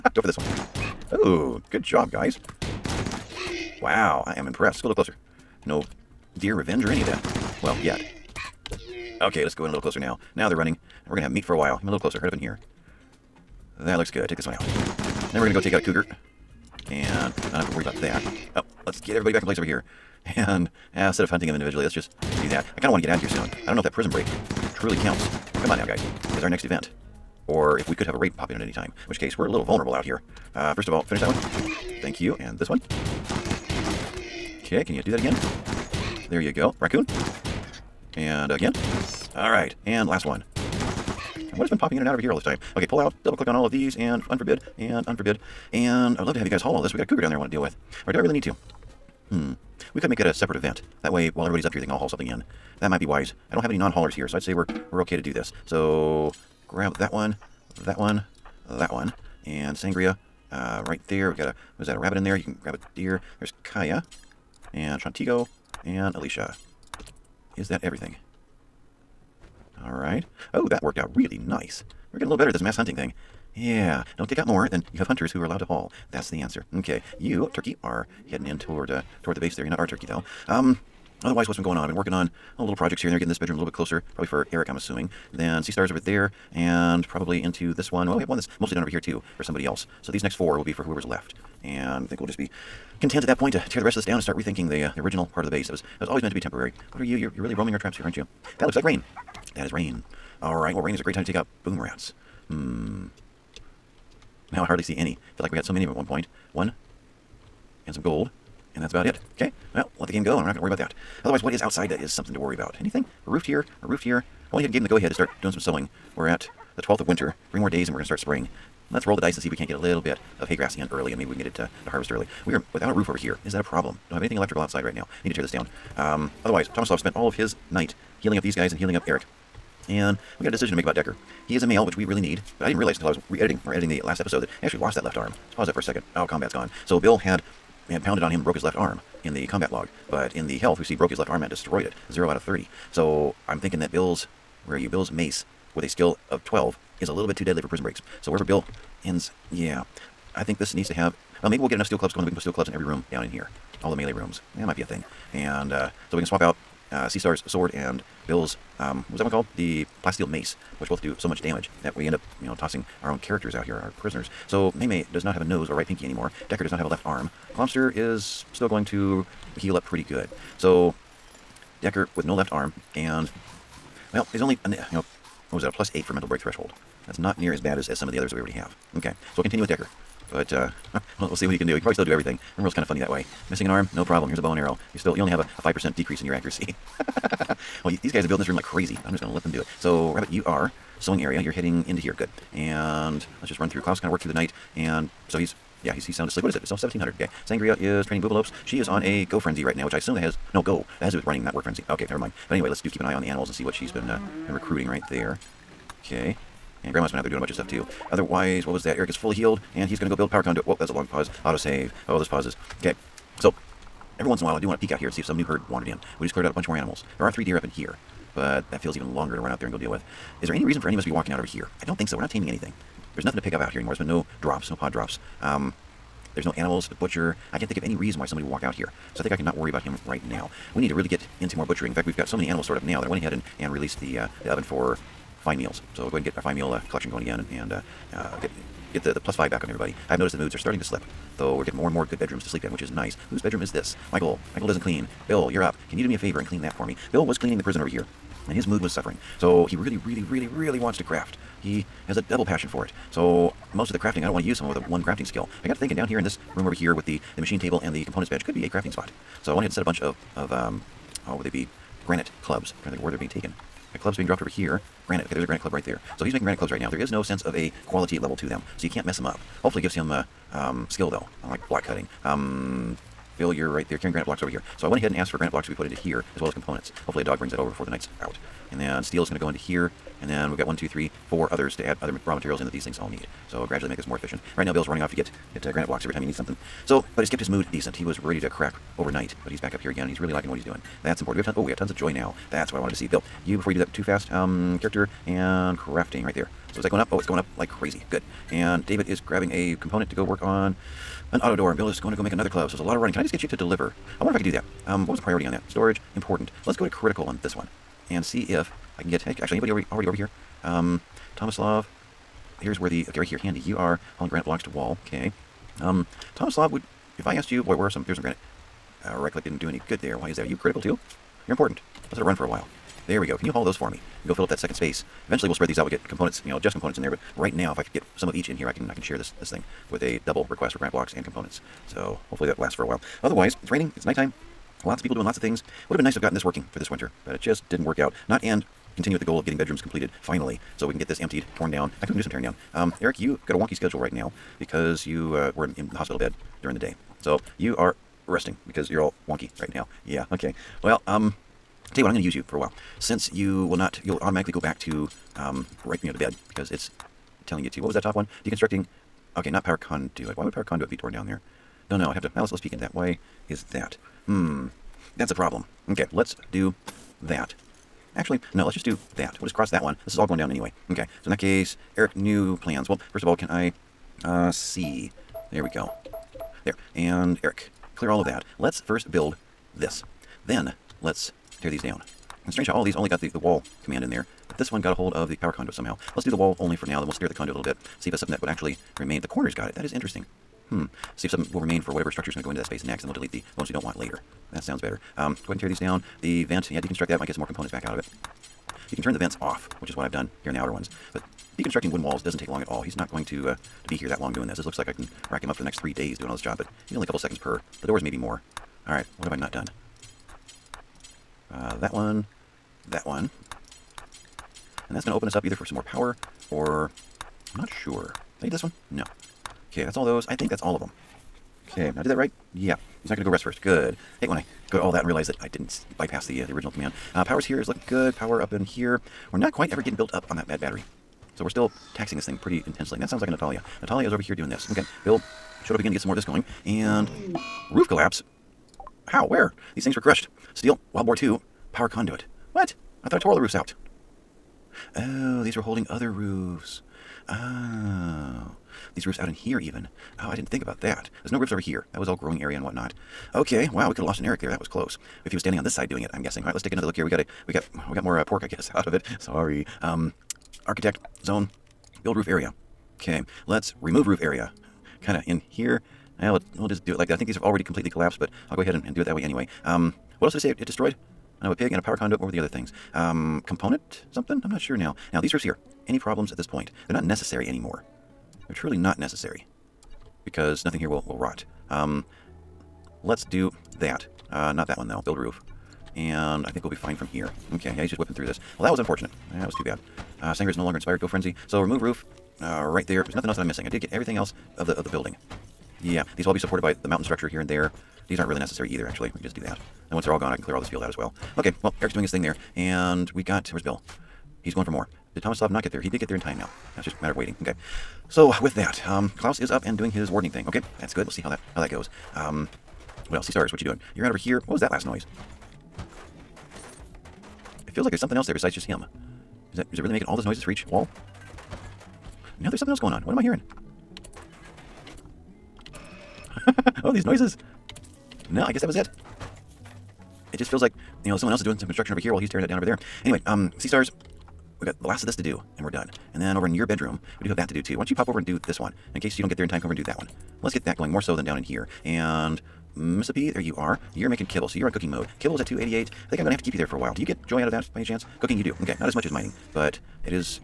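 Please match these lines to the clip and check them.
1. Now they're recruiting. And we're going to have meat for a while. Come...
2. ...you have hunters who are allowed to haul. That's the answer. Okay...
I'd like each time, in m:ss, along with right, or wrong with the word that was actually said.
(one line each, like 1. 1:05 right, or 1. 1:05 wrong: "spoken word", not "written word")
1. 0:10 wrong: "running", not "recruiting"
2. 1:14 right.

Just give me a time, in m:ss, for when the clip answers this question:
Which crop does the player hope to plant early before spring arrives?
2:00.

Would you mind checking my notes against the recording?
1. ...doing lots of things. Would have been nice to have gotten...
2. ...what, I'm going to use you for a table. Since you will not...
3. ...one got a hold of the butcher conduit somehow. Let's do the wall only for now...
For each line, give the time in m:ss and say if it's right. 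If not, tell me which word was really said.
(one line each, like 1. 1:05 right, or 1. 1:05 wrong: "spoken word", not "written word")
1. 5:35 right
2. 5:52 wrong: "while", not "table"
3. 6:24 wrong: "power", not "butcher".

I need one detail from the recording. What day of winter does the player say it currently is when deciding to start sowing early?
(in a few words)
12th.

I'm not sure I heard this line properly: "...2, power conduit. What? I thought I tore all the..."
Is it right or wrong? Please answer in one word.
right.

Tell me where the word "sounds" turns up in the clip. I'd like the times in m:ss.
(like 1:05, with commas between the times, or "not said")
3:16, 6:34, 7:13.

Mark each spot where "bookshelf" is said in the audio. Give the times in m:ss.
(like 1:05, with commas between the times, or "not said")
not said.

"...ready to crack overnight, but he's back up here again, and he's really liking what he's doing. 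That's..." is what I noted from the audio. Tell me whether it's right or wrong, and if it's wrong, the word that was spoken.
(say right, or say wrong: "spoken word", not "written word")
right.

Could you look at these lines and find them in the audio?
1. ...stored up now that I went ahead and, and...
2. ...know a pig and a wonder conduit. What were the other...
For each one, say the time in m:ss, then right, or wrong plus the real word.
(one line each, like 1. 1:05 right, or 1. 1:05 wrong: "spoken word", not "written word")
1. 3:52 right
2. 7:51 wrong: "power", not "wonder".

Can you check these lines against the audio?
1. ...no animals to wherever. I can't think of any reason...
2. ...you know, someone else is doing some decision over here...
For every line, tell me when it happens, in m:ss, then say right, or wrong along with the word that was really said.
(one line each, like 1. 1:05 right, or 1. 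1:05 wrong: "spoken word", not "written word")
1. 3:46 wrong: "butcher", not "wherever"
2. 8:51 wrong: "construction", not "decision".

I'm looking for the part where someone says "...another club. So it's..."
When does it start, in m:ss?
5:02.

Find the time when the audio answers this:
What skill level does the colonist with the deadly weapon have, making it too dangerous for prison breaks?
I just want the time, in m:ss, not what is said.
2:25.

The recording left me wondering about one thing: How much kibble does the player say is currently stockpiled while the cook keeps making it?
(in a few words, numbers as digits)
288.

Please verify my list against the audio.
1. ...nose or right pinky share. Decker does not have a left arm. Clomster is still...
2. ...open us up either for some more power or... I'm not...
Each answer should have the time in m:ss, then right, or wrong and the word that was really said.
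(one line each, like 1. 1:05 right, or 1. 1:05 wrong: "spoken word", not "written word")
1. 2:45 wrong: "anymore", not "share"
2. 6:55 right.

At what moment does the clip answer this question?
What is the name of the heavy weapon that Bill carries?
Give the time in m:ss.
2:40.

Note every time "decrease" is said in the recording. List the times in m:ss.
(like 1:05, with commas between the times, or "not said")
3:05.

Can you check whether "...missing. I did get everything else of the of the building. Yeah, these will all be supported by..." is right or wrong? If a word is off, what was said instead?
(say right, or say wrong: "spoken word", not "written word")
right.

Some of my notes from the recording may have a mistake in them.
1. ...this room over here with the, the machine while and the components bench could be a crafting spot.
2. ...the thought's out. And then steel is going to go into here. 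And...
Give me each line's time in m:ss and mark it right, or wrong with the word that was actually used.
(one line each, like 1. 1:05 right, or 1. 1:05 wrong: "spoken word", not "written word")
1. 4:16 wrong: "table", not "while"
2. 4:37 wrong: "night", not "thought".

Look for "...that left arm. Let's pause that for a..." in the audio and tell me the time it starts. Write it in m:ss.
2:14.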